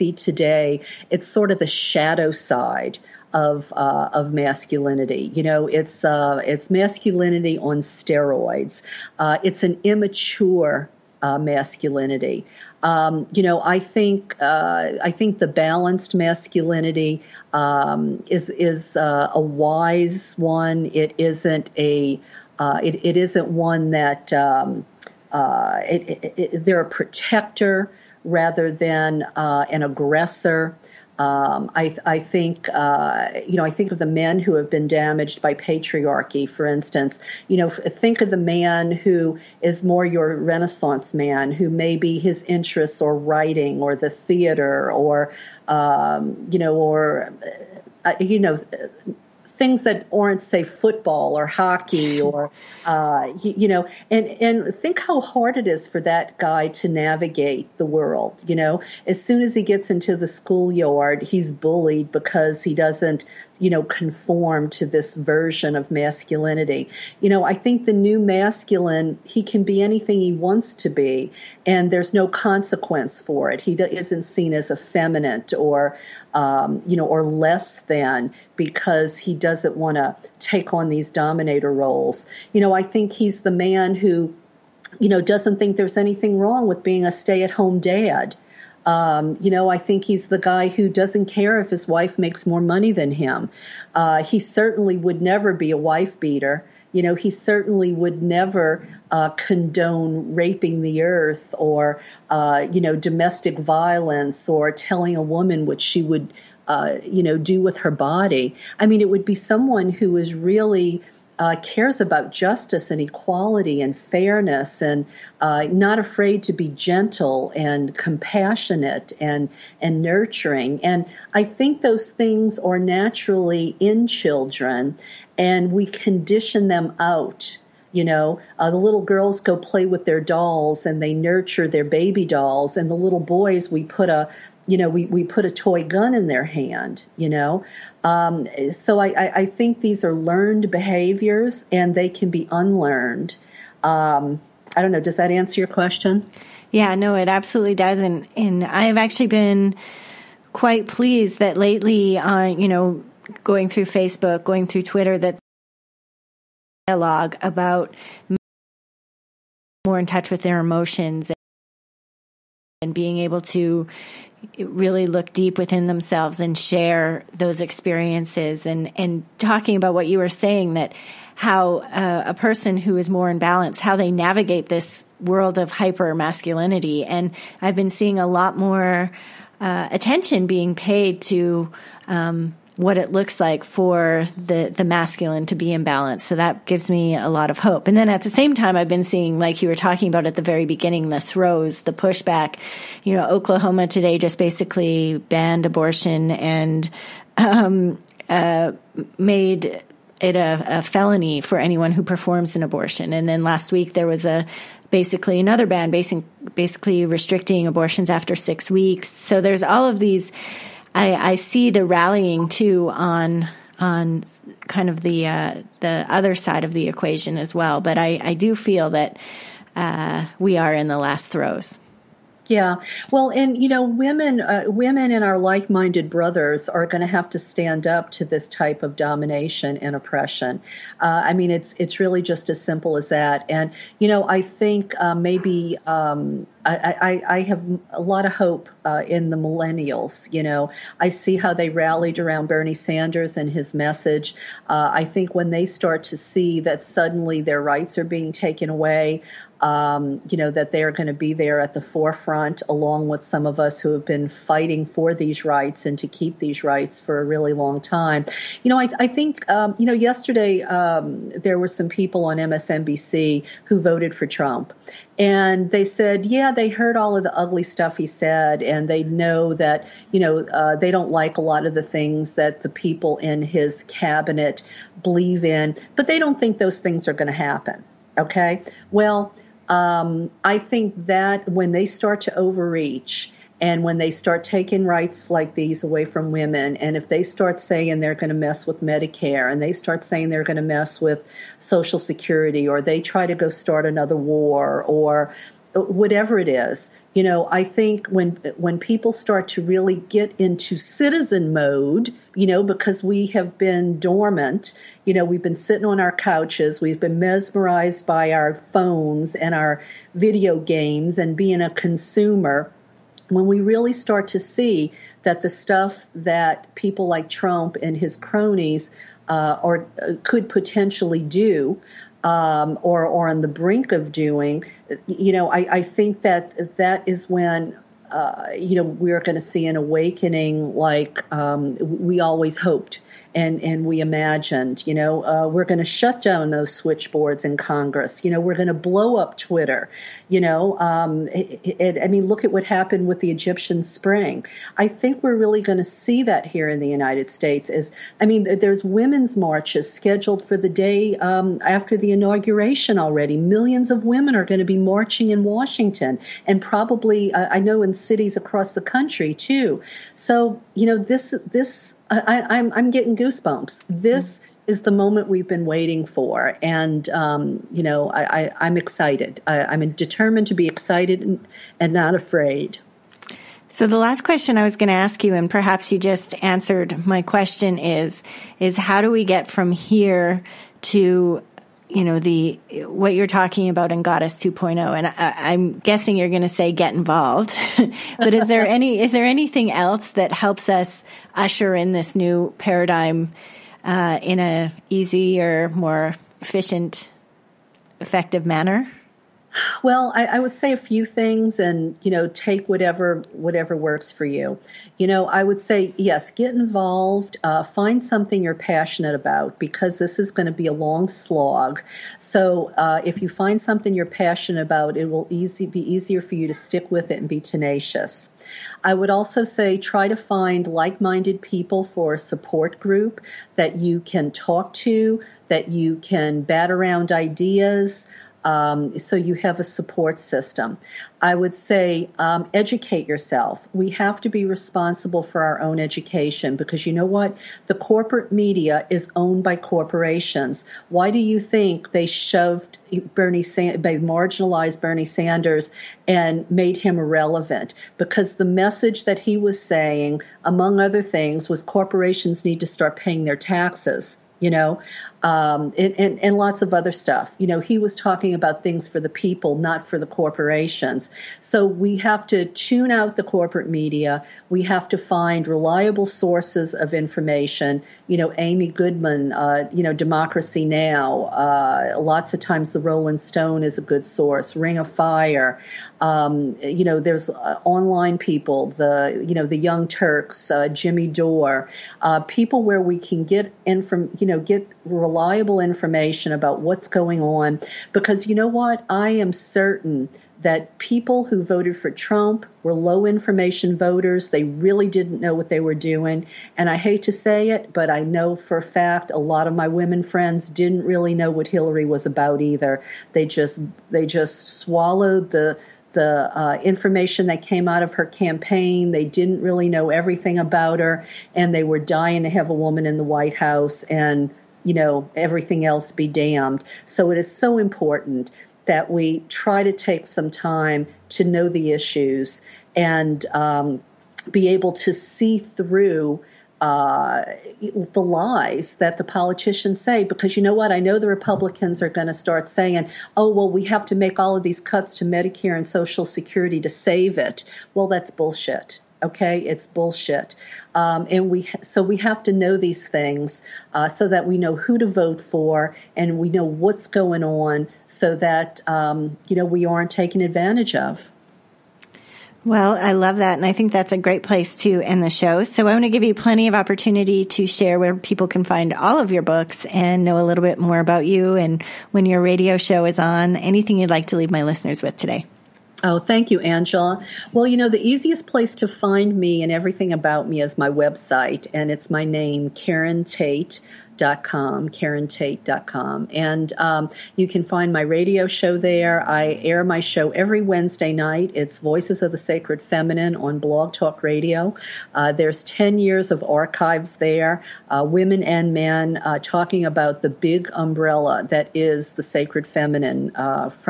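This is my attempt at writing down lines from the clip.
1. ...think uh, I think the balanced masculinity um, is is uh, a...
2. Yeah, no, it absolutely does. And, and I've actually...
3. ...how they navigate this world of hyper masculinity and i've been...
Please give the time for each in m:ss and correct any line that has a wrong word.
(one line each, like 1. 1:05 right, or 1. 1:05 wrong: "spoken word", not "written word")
1. 0:13 right
2. 2:26 right
3. 2:53 right.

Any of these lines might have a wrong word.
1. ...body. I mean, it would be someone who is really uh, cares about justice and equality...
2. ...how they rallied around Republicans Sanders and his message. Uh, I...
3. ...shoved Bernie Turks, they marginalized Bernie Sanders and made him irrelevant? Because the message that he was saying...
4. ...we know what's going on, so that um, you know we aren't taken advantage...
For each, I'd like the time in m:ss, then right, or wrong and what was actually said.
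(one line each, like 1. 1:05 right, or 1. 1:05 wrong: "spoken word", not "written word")
1. 1:47 right
2. 4:01 wrong: "Bernie", not "Republicans"
3. 7:22 wrong: "Sanders", not "Turks"
4. 9:06 right.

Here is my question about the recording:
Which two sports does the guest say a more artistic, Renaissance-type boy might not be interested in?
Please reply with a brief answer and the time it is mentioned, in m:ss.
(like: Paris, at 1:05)
football or hockey, at 0:50.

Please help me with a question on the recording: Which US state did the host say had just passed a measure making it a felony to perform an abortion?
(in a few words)
Oklahoma.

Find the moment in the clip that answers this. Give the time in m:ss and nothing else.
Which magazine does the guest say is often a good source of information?
7:52.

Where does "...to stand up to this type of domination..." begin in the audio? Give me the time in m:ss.
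3:47.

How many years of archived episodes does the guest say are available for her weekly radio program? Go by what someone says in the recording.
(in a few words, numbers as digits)
10.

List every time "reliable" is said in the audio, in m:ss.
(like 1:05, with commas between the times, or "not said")
7:45, 8:04.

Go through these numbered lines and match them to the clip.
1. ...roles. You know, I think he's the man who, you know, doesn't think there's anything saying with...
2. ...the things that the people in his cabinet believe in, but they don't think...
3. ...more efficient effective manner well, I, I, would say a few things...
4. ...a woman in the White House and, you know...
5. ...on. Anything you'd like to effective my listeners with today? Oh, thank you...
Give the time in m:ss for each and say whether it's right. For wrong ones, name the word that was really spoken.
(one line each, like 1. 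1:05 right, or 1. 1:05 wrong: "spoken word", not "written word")
1. 1:21 wrong: "wrong", not "saying"
2. 4:31 right
3. 6:35 right
4. 8:32 right
5. 9:22 wrong: "leave", not "effective".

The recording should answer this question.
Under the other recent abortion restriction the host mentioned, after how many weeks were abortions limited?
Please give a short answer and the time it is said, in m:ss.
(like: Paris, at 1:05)
6, at 3:28.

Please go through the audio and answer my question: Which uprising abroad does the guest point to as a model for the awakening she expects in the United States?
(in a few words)
Egyptian Spring.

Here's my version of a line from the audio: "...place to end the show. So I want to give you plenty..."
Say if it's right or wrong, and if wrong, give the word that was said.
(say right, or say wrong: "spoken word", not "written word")
right.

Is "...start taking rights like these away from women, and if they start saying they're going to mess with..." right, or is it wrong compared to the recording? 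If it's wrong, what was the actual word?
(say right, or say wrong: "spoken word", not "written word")
right.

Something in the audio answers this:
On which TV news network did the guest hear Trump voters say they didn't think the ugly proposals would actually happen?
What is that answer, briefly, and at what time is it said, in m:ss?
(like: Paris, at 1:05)
MSNBC, at 4:22.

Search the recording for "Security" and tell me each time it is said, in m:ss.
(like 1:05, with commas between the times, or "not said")
4:51, 8:56.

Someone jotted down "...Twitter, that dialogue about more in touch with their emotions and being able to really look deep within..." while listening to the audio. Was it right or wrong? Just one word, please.
right.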